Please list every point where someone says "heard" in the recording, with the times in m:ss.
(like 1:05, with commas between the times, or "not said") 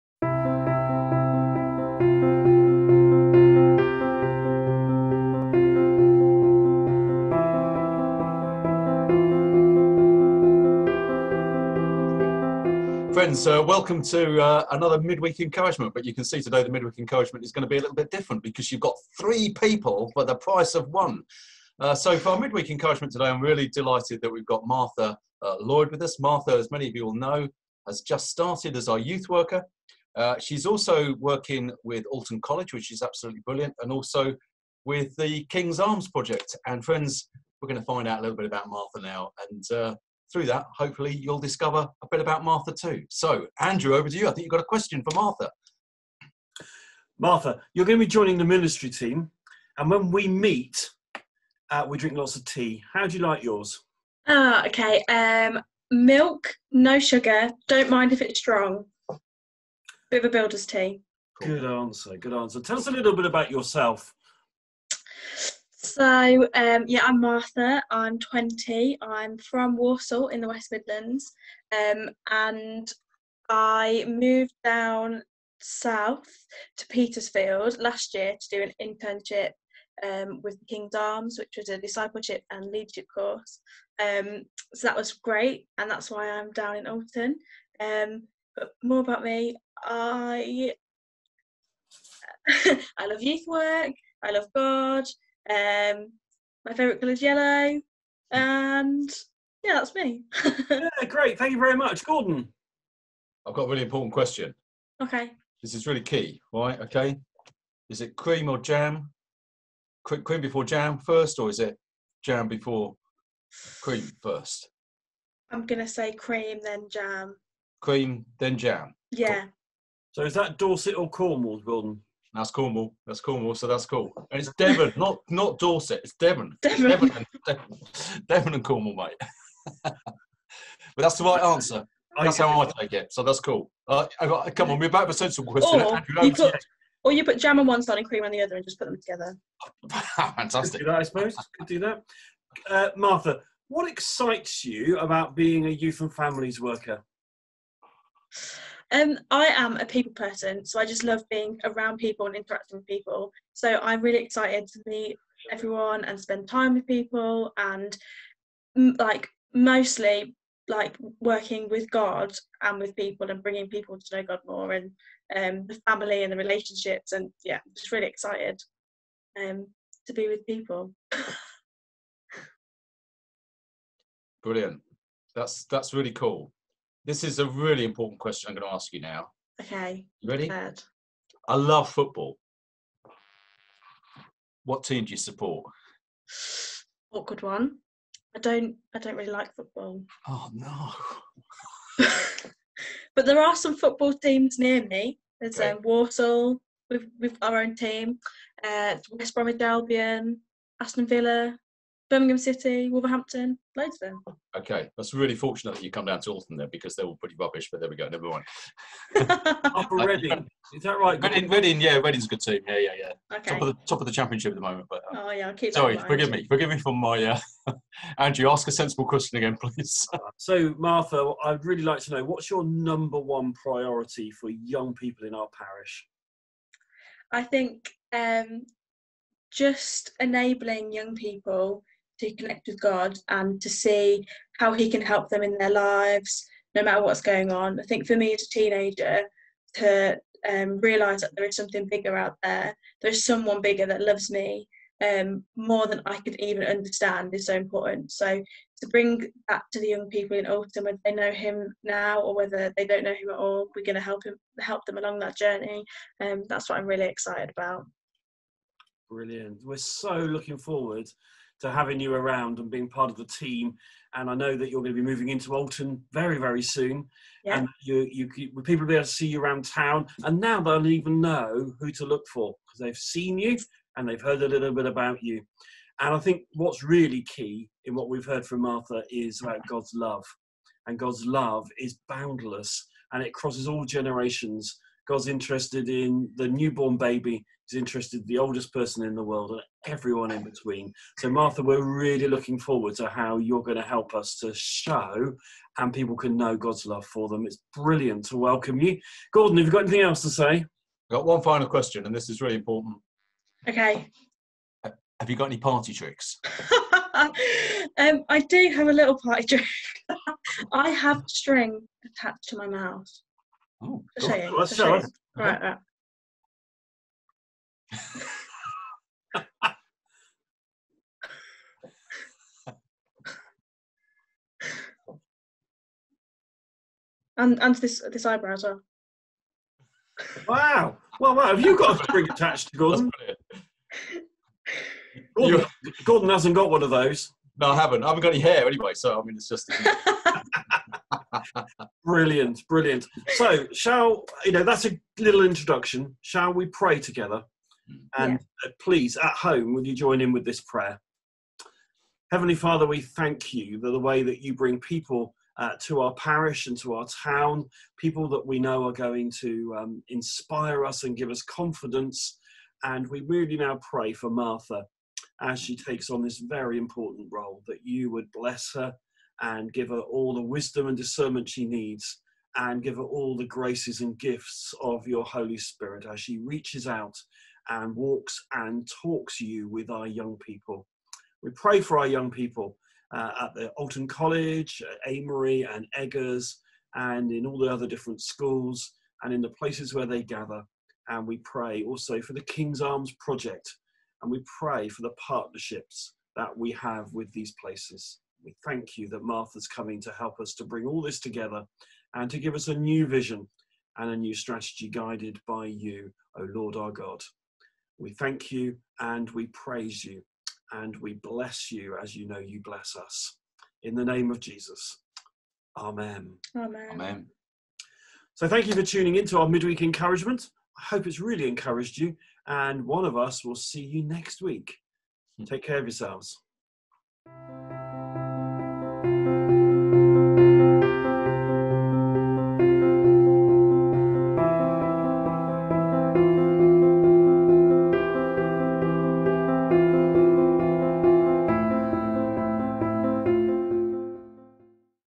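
4:34, 4:38.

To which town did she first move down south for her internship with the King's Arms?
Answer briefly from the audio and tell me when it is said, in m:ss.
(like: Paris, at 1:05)
Petersfield, at 1:16.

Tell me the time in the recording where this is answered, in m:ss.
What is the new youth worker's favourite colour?
1:37.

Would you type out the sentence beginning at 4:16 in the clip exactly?
Um, that's what I'm really excited about.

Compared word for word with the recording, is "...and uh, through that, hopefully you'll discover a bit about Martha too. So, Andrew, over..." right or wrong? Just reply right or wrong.
right.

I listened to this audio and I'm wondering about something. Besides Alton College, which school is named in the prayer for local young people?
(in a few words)
Amery and Eggar's.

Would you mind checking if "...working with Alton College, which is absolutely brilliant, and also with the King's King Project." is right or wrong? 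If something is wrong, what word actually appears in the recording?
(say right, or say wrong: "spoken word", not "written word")
wrong: "Arms", not "King".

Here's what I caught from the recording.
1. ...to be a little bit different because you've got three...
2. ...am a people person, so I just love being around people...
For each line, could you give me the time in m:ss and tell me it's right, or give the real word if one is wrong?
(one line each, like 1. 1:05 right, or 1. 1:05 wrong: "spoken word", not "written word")
1. 0:17 right
2. 2:29 right.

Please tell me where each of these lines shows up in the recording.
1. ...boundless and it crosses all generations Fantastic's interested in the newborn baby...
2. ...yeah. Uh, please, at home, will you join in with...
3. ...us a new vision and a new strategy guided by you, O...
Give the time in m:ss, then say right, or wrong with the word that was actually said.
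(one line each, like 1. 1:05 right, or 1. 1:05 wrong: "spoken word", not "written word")
1. 4:42 wrong: "God", not "Fantastic"
2. 5:48 right
3. 6:42 right.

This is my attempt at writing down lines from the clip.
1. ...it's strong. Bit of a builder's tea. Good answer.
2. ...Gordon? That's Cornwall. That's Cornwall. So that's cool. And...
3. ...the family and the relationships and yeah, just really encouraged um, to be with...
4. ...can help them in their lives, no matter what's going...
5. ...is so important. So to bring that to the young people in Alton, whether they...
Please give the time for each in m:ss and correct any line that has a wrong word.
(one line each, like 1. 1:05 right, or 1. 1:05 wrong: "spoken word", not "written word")
1. 0:58 right
2. 2:01 right
3. 2:45 wrong: "excited", not "encouraged"
4. 3:54 right
5. 4:07 right.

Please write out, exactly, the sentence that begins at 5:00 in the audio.
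I've got one final question, and this is really important.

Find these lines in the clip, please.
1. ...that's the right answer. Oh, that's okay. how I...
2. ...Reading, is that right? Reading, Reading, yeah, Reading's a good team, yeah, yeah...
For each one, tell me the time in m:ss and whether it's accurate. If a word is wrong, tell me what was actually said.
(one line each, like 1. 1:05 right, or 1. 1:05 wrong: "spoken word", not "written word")
1. 2:10 right
2. 3:29 right.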